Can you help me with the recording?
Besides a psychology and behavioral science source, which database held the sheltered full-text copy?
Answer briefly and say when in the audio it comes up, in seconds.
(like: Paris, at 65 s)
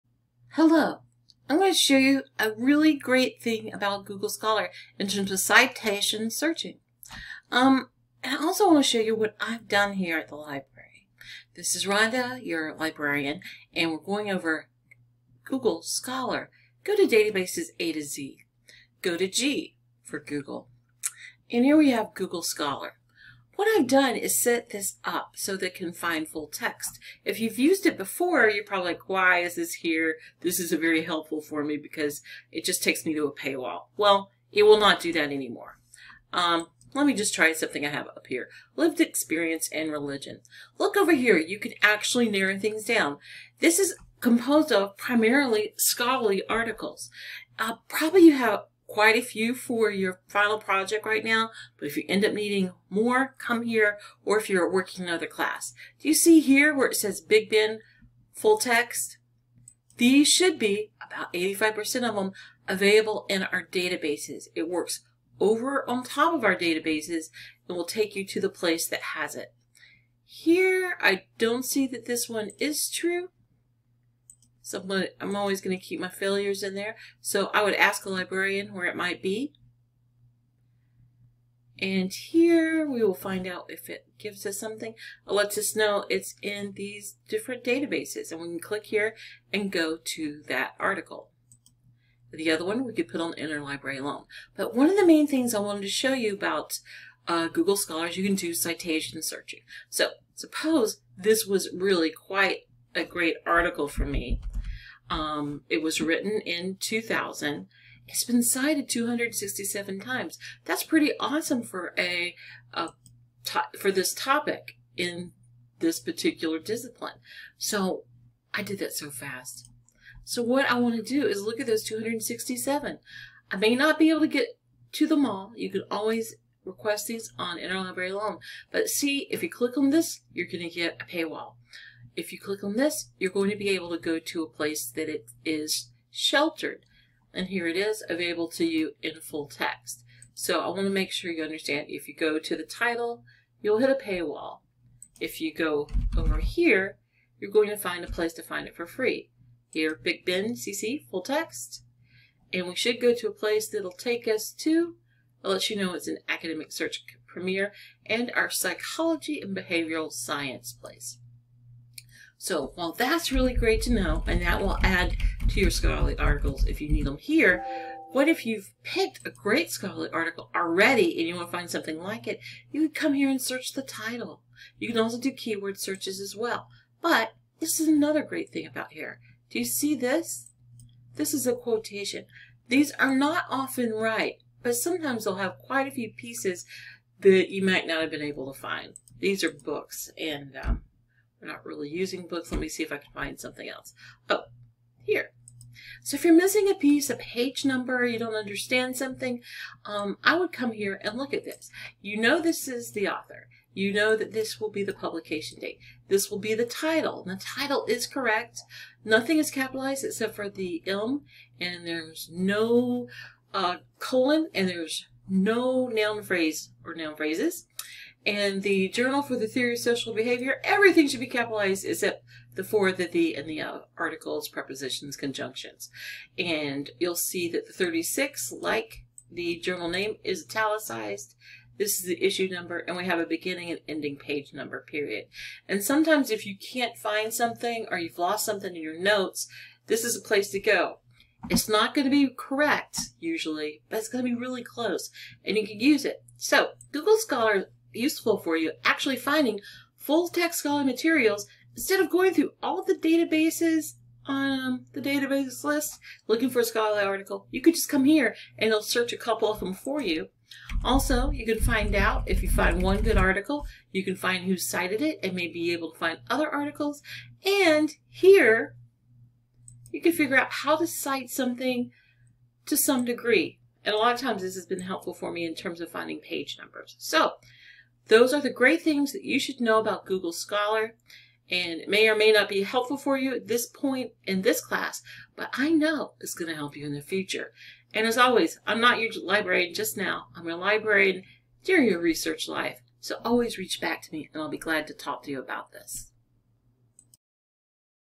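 Academic Search Premier, at 156 s.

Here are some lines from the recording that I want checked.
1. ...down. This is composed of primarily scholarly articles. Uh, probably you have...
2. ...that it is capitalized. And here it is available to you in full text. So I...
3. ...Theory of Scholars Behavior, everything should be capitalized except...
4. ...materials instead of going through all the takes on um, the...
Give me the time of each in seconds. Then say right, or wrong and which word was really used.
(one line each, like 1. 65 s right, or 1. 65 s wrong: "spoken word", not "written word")
1. 42 s right
2. 134 s wrong: "sheltered", not "capitalized"
3. 219 s wrong: "Social", not "Scholars"
4. 250 s wrong: "databases", not "takes".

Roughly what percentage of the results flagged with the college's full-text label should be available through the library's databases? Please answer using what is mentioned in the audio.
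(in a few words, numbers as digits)
85%.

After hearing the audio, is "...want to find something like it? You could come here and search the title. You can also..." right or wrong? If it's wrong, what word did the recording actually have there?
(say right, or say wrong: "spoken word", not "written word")
right.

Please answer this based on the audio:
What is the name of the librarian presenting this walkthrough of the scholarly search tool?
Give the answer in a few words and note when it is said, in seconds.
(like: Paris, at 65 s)
Rhonda, at 11 s.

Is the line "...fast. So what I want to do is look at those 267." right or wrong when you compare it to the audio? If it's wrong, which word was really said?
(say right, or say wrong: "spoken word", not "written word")
right.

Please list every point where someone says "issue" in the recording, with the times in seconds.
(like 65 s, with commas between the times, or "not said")
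232 s.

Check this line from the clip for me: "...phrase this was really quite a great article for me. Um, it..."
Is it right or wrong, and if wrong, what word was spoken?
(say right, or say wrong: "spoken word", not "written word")
wrong: "suppose", not "phrase".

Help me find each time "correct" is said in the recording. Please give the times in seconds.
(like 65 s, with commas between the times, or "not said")
208 s, 242 s.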